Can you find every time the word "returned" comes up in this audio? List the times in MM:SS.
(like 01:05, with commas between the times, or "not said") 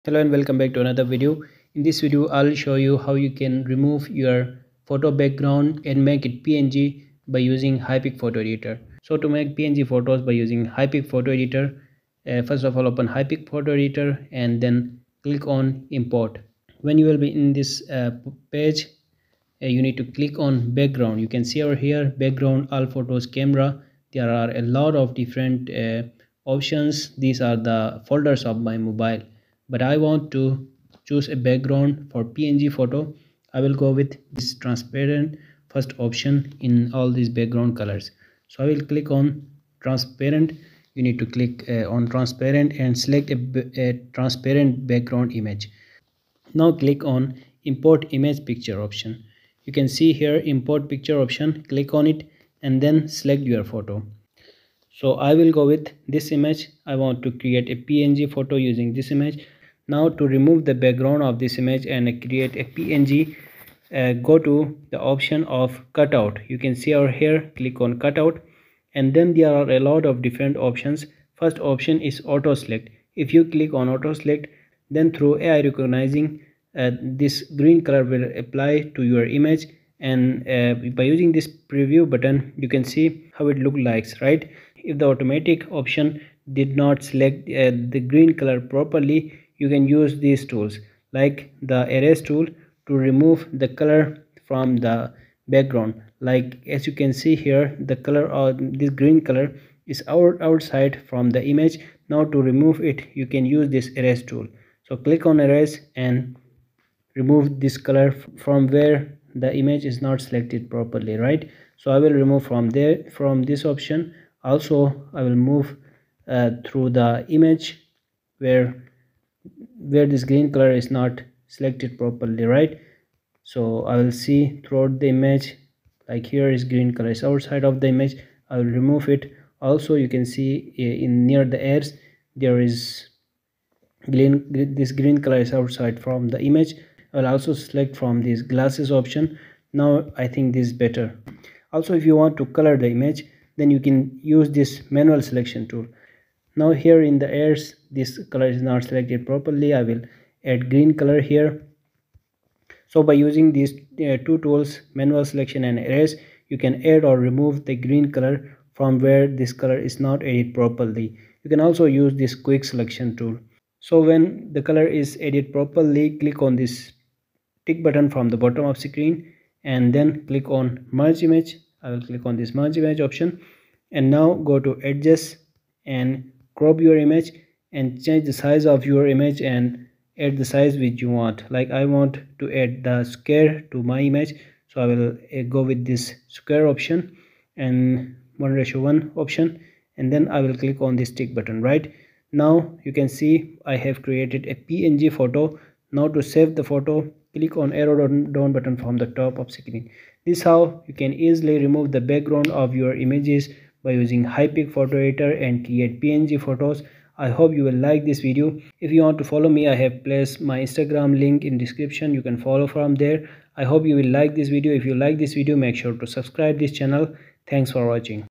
not said.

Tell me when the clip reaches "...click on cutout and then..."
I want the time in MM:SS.
01:07.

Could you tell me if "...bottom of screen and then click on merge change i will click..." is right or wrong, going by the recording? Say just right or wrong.
wrong.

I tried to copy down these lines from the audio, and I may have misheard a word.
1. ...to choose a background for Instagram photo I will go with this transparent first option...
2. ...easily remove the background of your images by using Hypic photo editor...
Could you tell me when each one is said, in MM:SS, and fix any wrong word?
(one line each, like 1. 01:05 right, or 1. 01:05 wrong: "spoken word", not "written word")
1. 00:30 wrong: "PNG", not "Instagram"
2. 03:21 right.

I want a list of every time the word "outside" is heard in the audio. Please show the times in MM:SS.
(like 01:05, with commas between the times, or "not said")
01:40, 02:07, 02:15.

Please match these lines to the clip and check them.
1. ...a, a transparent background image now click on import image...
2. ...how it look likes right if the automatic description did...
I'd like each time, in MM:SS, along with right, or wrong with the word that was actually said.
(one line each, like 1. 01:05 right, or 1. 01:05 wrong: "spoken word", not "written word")
1. 00:43 right
2. 01:23 wrong: "option", not "description".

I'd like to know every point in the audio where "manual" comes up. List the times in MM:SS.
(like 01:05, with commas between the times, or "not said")
02:24, 02:34.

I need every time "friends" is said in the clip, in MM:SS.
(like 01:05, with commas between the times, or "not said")
not said.